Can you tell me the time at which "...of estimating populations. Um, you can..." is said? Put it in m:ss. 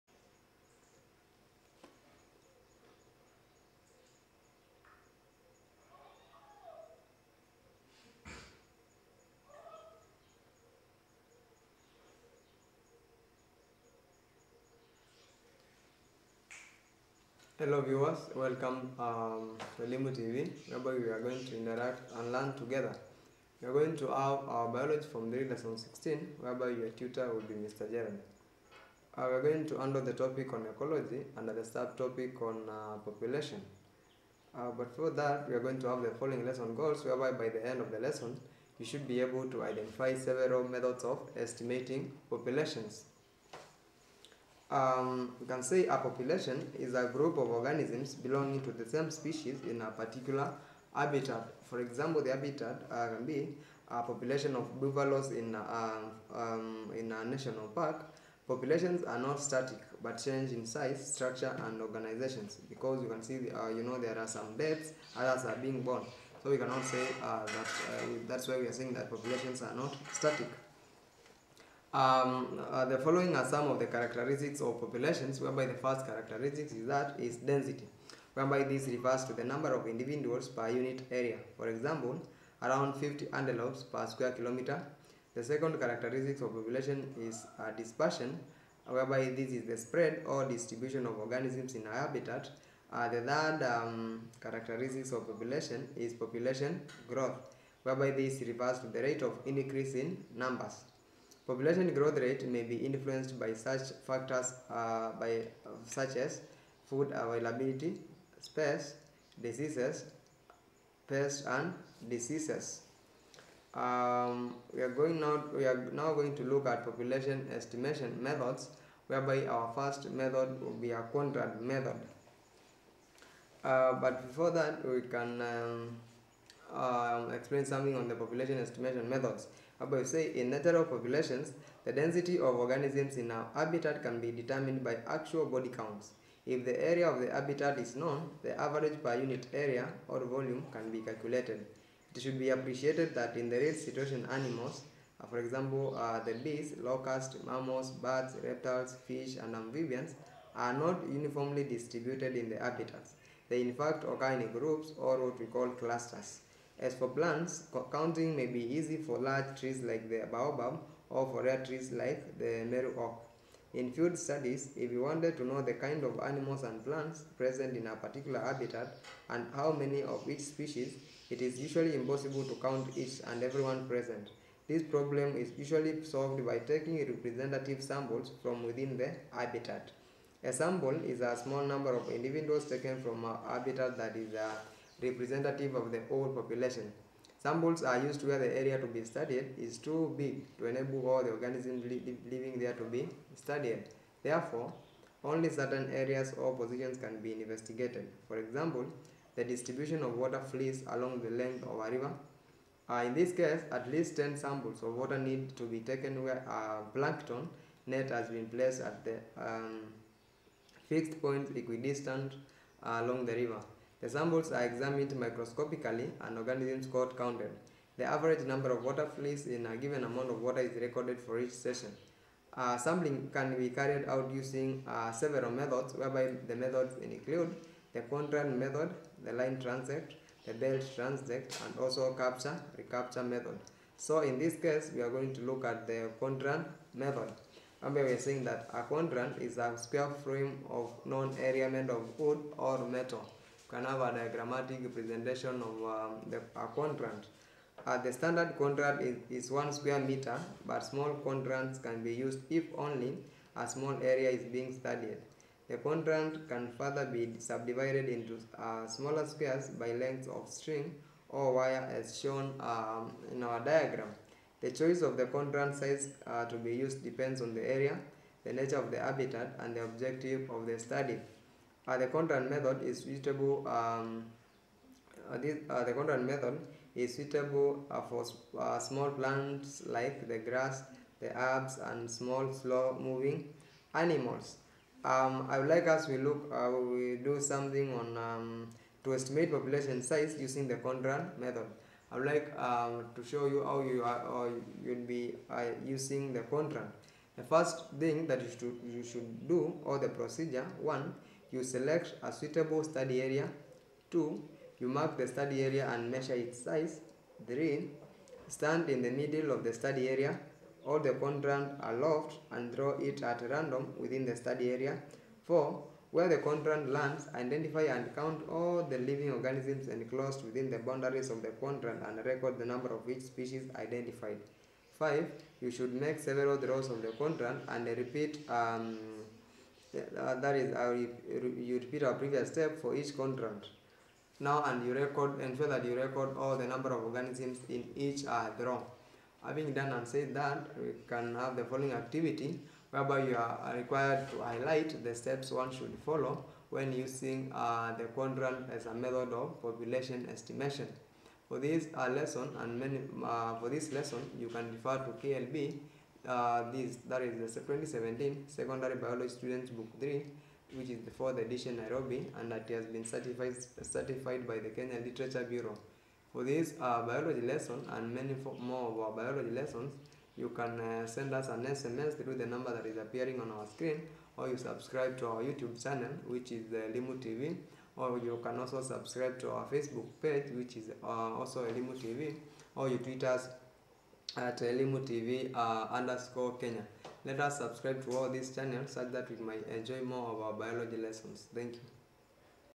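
0:41.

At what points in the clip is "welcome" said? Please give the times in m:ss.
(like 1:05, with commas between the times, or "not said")
0:18.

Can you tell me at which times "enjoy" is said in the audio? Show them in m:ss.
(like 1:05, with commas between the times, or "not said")
6:29.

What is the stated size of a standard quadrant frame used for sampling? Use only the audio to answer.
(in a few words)
1 square meter.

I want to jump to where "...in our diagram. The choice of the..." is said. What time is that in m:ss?
4:23.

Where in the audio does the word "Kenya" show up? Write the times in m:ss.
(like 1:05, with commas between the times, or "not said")
6:04, 6:26.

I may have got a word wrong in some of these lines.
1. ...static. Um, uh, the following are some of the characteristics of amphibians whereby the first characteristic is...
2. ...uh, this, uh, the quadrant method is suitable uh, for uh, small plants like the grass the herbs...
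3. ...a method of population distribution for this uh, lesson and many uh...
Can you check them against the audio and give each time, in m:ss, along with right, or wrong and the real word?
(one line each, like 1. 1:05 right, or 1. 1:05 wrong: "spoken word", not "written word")
1. 1:10 wrong: "populations", not "amphibians"
2. 4:35 right
3. 5:48 wrong: "estimation", not "distribution".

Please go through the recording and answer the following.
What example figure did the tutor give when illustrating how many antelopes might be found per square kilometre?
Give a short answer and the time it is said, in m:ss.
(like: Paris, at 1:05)
50, at 1:22.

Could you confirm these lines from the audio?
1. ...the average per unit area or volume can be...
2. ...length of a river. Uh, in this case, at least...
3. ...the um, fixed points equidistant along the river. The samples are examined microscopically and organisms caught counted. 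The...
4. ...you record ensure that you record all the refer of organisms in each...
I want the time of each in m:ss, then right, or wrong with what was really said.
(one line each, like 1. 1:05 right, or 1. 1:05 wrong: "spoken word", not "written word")
1. 2:18 right
2. 3:21 right
3. 3:29 right
4. 5:34 wrong: "number", not "refer".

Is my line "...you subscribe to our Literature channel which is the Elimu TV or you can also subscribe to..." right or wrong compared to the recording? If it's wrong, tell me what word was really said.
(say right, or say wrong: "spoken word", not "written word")
wrong: "YouTube", not "Literature".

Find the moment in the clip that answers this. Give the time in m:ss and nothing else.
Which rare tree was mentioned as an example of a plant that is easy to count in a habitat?
2:42.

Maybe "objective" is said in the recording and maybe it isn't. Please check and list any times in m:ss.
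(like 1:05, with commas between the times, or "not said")
4:29.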